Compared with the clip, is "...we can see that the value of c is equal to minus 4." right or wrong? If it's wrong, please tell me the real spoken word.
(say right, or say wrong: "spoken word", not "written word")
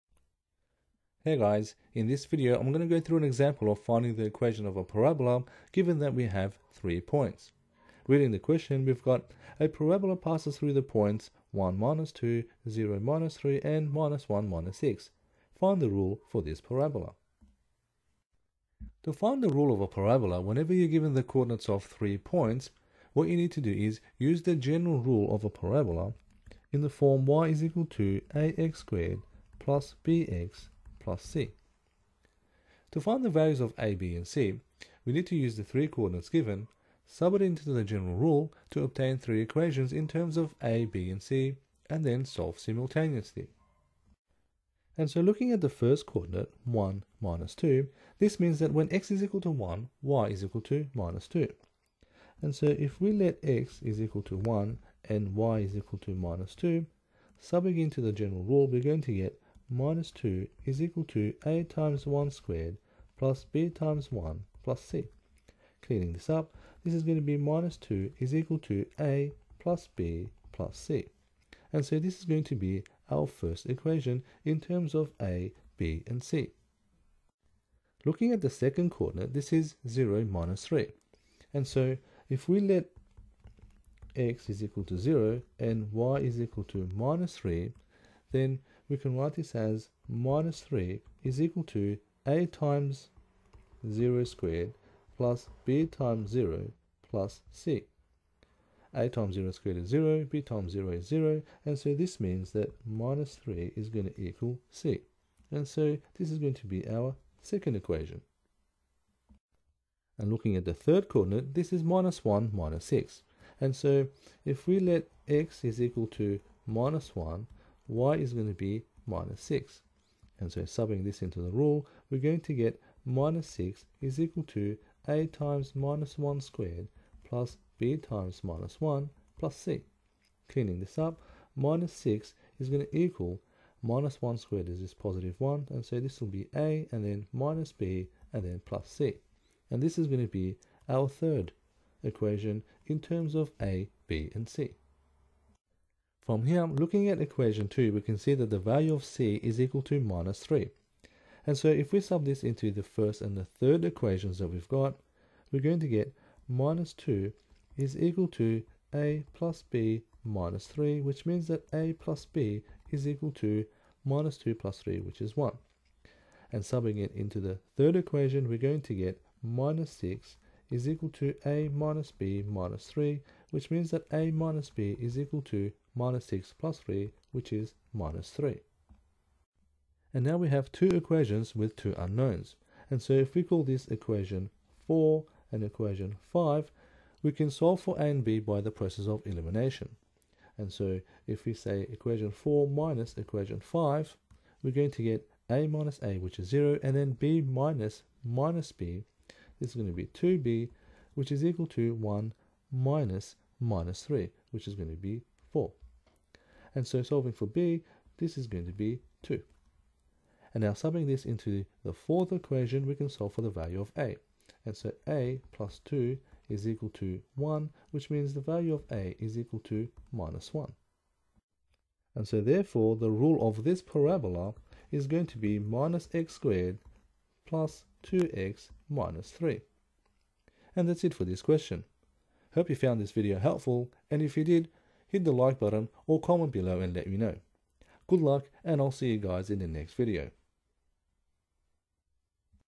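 wrong: "3", not "4".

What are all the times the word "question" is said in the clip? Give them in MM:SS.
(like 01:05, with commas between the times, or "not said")
00:08, 03:51.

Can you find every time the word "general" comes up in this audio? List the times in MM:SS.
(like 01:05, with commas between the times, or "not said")
00:24, 00:37, 00:58.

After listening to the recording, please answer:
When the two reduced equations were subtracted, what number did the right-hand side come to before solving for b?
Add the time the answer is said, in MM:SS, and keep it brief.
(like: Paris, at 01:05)
4, at 03:24.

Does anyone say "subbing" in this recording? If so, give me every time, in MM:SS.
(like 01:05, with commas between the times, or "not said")
00:57, 02:00, 02:46, 03:30.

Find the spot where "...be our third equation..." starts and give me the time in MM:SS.
02:20.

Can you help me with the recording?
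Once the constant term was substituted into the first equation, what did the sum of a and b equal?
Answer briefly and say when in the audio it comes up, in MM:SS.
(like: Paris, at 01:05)
1, at 02:44.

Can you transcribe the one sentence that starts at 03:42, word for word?
And so therefore, the rule of this parabola is going to be minus x squared plus 2x minus 3.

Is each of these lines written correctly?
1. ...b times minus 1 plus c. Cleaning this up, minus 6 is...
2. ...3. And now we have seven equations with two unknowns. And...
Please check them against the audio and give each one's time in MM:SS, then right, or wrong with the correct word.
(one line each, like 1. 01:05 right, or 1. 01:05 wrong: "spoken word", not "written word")
1. 02:07 right
2. 02:58 wrong: "two", not "seven".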